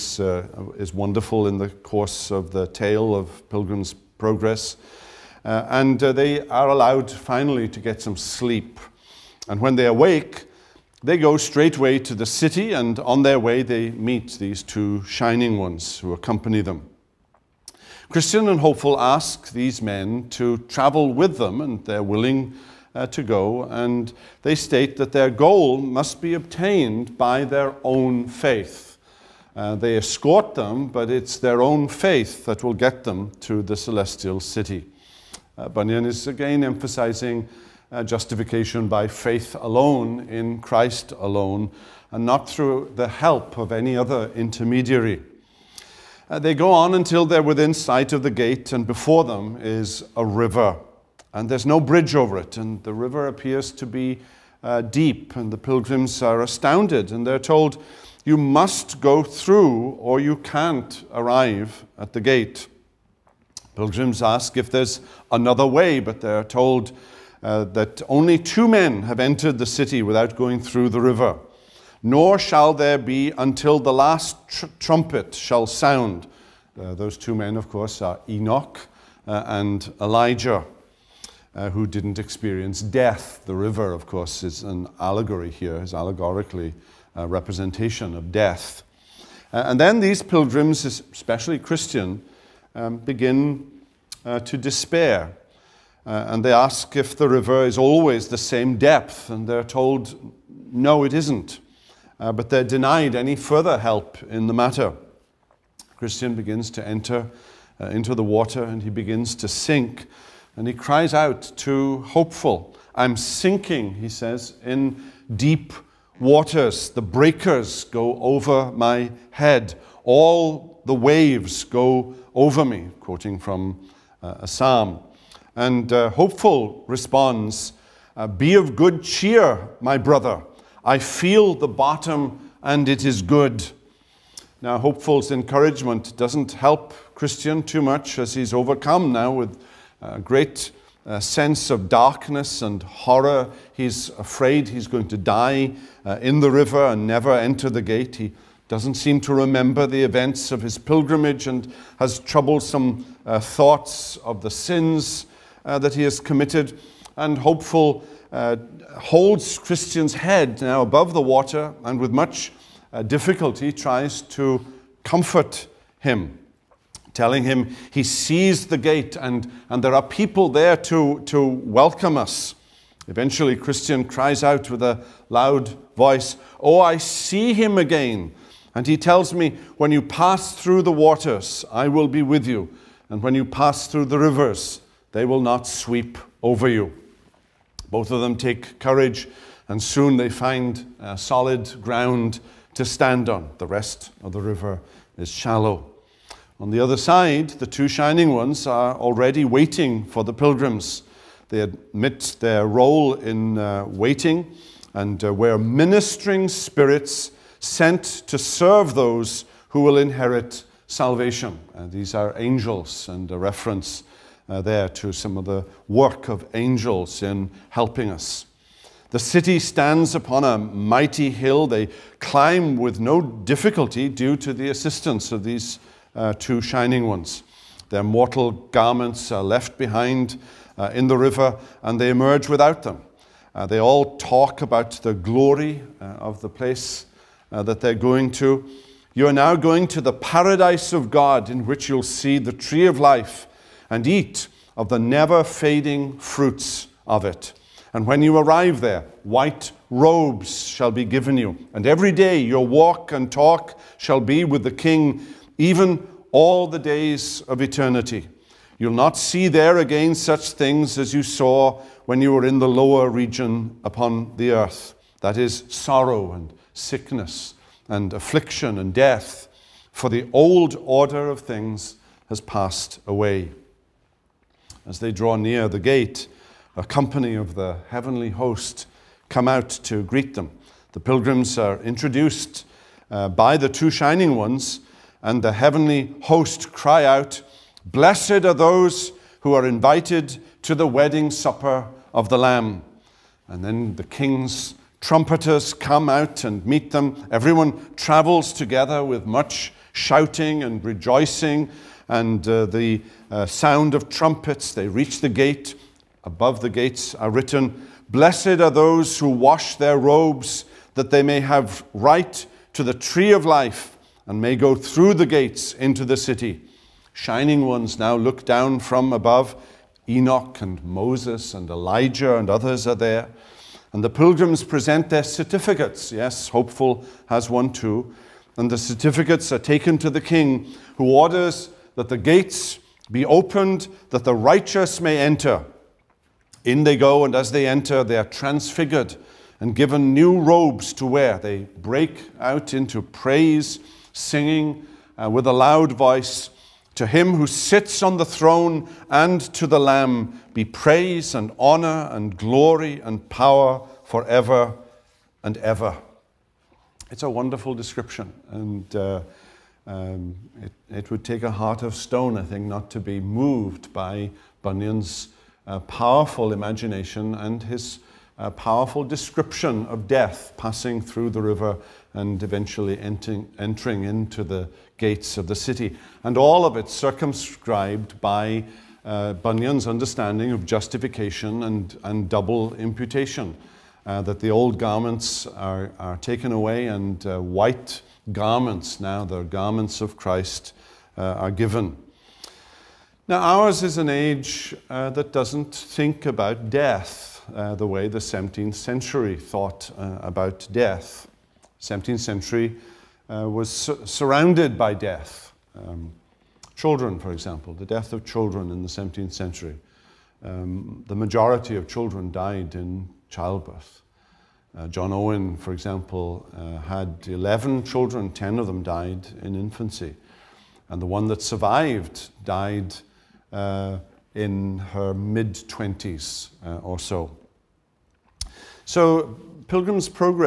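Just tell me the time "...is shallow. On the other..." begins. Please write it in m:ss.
3:15.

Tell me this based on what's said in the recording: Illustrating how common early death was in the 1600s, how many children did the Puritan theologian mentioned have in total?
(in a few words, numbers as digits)
11.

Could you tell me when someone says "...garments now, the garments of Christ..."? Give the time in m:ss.
6:28.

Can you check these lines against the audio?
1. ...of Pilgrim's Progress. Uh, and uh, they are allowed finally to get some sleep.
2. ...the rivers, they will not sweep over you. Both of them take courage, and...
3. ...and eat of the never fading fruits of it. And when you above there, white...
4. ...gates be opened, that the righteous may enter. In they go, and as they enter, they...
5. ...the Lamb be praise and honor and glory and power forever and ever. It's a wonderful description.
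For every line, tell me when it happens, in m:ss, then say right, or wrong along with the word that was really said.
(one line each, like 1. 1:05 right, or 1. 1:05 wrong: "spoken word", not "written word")
1. 0:03 right
2. 3:04 right
3. 4:03 wrong: "arrive", not "above"
4. 5:32 right
5. 5:49 right.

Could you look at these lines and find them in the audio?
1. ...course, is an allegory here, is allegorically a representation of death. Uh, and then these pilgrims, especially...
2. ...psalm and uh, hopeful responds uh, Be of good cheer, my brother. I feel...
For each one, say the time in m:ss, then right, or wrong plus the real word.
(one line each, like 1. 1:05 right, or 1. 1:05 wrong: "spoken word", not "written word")
1. 1:24 right
2. 2:04 right.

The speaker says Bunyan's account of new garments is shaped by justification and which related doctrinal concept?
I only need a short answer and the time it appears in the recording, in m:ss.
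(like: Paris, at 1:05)
Double imputation, at 6:22.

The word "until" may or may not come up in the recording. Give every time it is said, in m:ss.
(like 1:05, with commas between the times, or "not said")
0:46, 1:13.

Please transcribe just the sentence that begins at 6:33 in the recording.
Now, ours is an age uh, that doesn't think about death uh, the way the 17th century thought uh, about death.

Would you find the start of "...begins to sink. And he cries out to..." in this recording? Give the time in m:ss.
1:48.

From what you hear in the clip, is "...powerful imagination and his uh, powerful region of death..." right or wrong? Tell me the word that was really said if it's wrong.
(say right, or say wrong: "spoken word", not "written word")
wrong: "description", not "region".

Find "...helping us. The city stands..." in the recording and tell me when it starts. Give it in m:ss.
3:37.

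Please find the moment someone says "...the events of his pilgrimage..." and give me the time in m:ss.
2:29.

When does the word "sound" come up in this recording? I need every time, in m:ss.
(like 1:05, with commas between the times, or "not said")
1:15, 5:03.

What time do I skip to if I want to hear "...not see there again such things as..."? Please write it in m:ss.
4:18.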